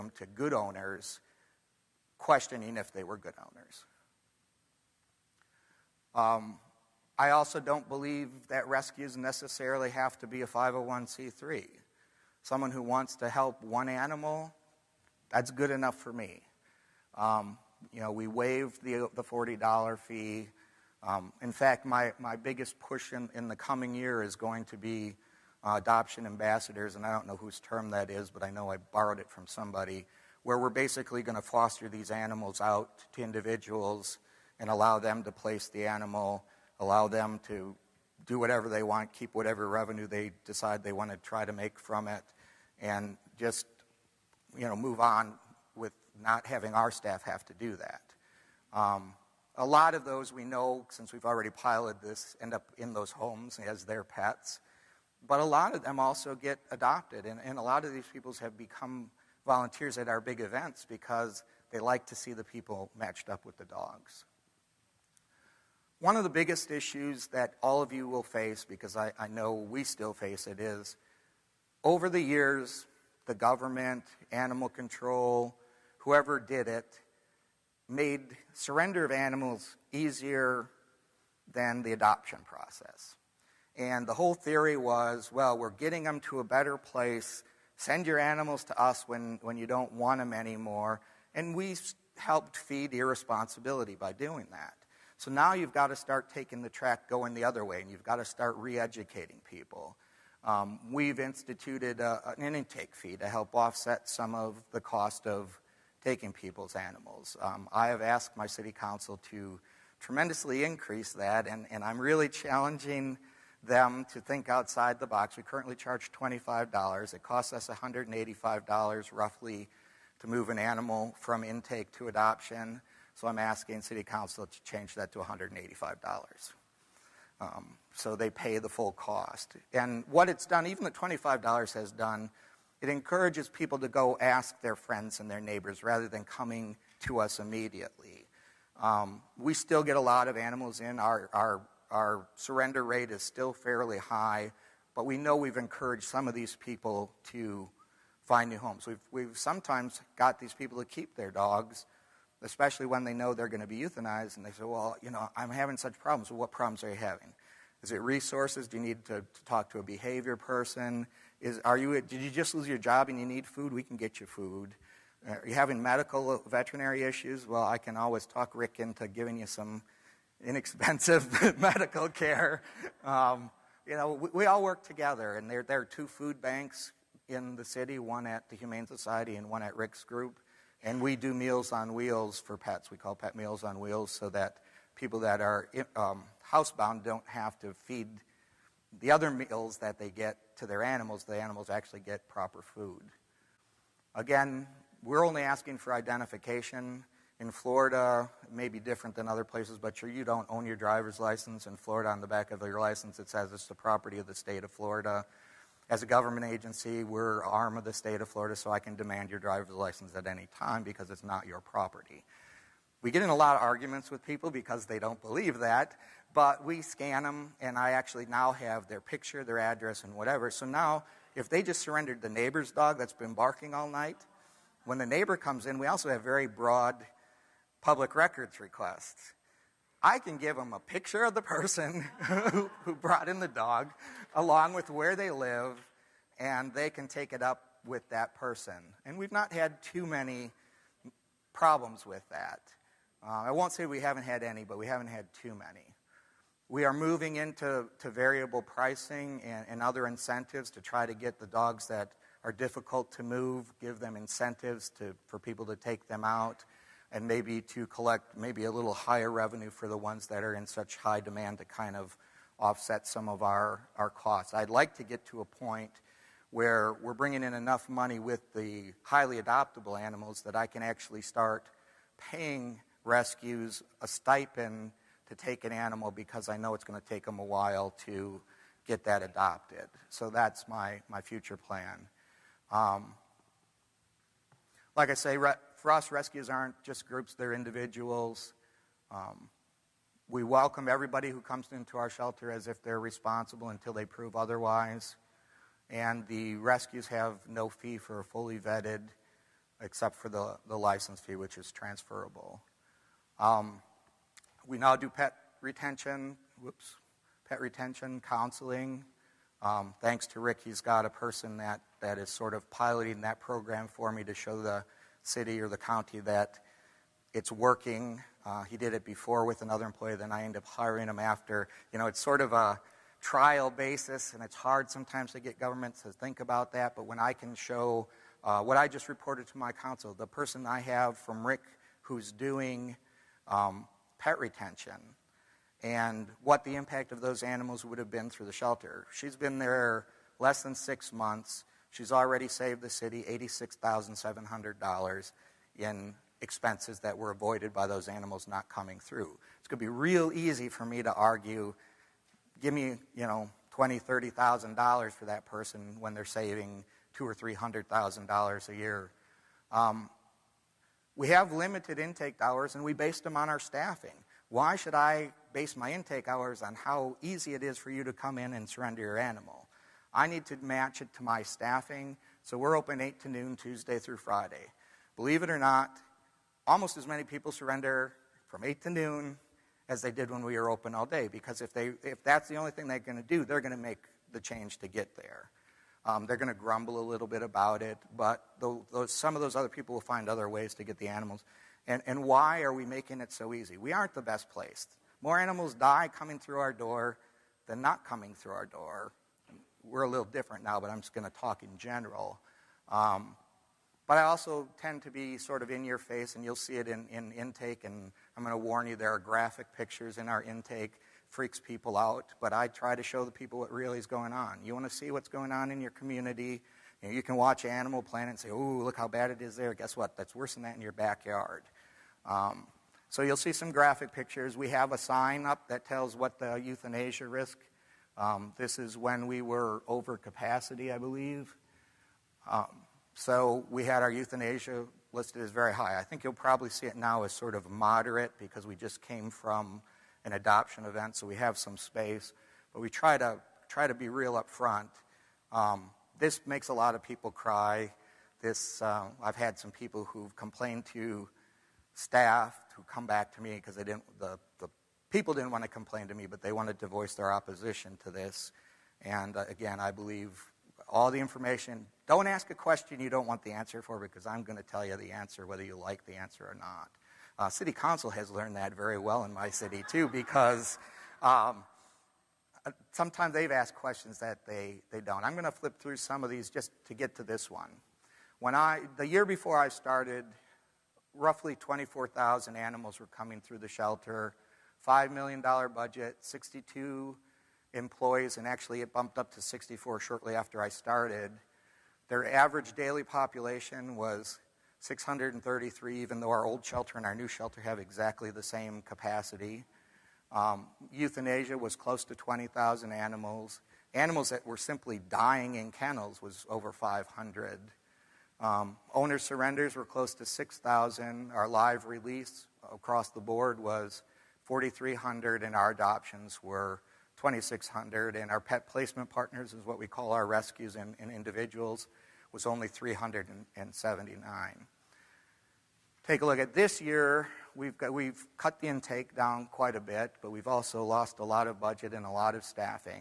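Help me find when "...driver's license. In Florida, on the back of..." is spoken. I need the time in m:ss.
3:20.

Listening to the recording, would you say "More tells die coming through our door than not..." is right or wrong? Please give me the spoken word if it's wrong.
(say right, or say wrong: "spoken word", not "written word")
wrong: "animals", not "tells".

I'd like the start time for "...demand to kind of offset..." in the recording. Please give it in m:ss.
4:21.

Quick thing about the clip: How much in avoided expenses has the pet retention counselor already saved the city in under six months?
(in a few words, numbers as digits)
$86,700.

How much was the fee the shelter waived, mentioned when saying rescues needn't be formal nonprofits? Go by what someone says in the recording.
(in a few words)
$40.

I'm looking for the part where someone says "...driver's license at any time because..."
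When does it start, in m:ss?
3:29.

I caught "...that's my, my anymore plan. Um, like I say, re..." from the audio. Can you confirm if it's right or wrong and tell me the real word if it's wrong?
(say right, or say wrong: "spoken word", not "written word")
wrong: "future", not "anymore".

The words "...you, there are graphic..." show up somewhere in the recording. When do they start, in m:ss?
6:48.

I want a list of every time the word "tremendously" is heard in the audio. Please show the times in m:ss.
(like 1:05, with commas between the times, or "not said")
1:50.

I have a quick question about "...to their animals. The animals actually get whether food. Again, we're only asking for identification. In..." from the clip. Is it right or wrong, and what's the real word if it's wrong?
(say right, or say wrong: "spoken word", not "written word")
wrong: "proper", not "whether".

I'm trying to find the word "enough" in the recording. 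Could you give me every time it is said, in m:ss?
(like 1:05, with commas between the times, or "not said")
0:15, 4:27.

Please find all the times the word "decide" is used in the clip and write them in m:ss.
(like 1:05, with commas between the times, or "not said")
0:40.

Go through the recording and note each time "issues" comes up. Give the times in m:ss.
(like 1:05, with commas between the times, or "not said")
1:06, 2:47.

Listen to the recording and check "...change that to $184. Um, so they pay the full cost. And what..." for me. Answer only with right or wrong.
wrong.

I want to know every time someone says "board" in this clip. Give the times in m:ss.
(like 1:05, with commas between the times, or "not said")
8:33.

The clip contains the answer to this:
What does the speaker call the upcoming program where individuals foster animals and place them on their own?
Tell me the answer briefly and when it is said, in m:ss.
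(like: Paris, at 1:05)
adoption ambassadors, at 0:25.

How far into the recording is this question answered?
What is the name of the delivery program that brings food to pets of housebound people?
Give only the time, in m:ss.
3:03.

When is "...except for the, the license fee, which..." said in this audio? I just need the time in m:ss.
4:59.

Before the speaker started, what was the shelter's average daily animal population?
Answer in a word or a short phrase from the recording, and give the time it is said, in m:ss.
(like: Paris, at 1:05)
633, at 8:14.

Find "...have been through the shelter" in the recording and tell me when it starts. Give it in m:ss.
5:37.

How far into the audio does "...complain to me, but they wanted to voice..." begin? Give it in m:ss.
7:35.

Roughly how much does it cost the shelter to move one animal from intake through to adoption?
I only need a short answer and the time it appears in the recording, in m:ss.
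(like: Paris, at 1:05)
$185, at 1:57.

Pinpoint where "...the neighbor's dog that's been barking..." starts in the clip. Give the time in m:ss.
3:42.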